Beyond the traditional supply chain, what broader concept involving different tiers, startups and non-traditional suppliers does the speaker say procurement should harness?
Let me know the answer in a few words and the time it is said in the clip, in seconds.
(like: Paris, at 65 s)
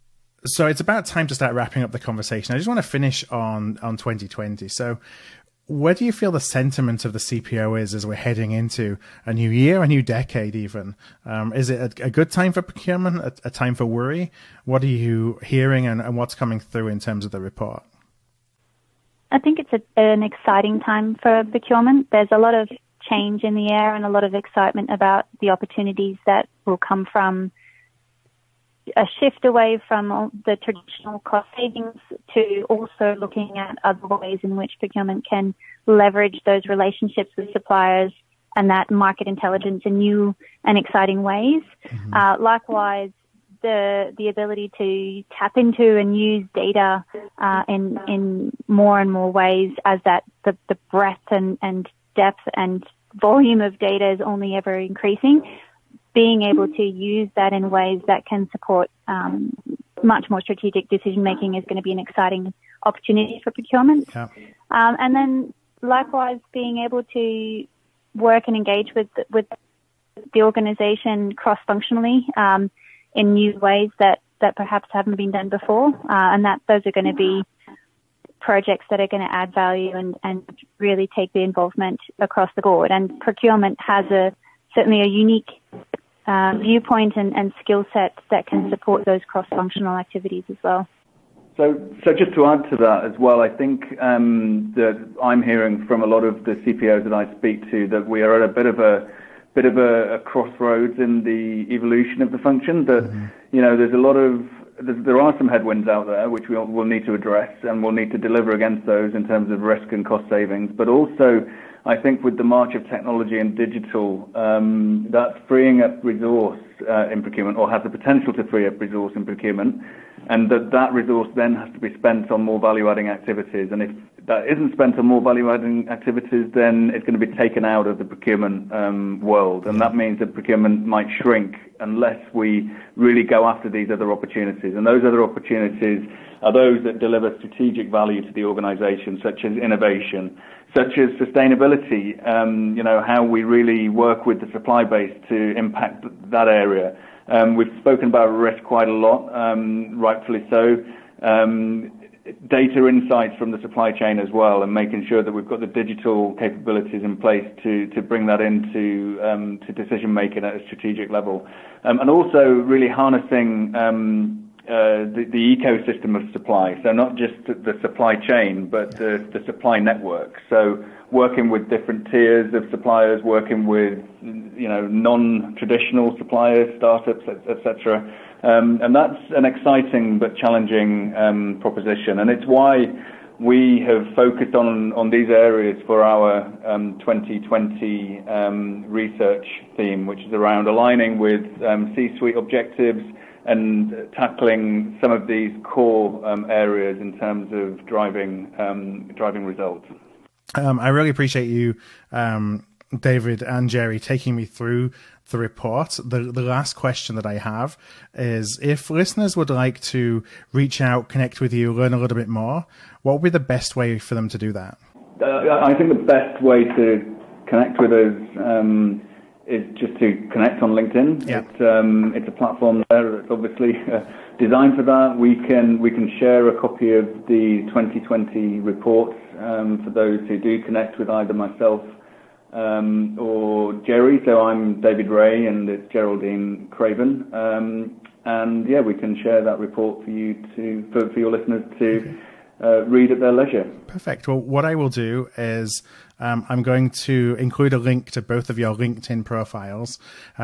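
Supply network, at 169 s.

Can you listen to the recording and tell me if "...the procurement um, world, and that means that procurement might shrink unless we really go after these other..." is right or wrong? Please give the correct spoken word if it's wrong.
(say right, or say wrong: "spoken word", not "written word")
right.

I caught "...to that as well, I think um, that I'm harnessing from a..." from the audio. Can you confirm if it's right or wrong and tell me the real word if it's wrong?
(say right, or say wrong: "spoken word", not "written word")
wrong: "hearing", not "harnessing".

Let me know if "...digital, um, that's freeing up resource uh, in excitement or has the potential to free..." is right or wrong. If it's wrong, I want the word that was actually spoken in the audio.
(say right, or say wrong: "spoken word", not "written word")
wrong: "procurement", not "excitement".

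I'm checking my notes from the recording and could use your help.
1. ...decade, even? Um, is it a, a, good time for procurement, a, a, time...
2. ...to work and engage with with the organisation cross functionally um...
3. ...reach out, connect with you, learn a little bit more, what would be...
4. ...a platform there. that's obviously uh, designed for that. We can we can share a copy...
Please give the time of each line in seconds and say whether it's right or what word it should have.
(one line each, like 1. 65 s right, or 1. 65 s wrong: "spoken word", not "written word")
1. 10 s right
2. 67 s right
3. 210 s right
4. 222 s right.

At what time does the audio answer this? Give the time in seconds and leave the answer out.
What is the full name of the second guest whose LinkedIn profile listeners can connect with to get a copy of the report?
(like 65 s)
235 s.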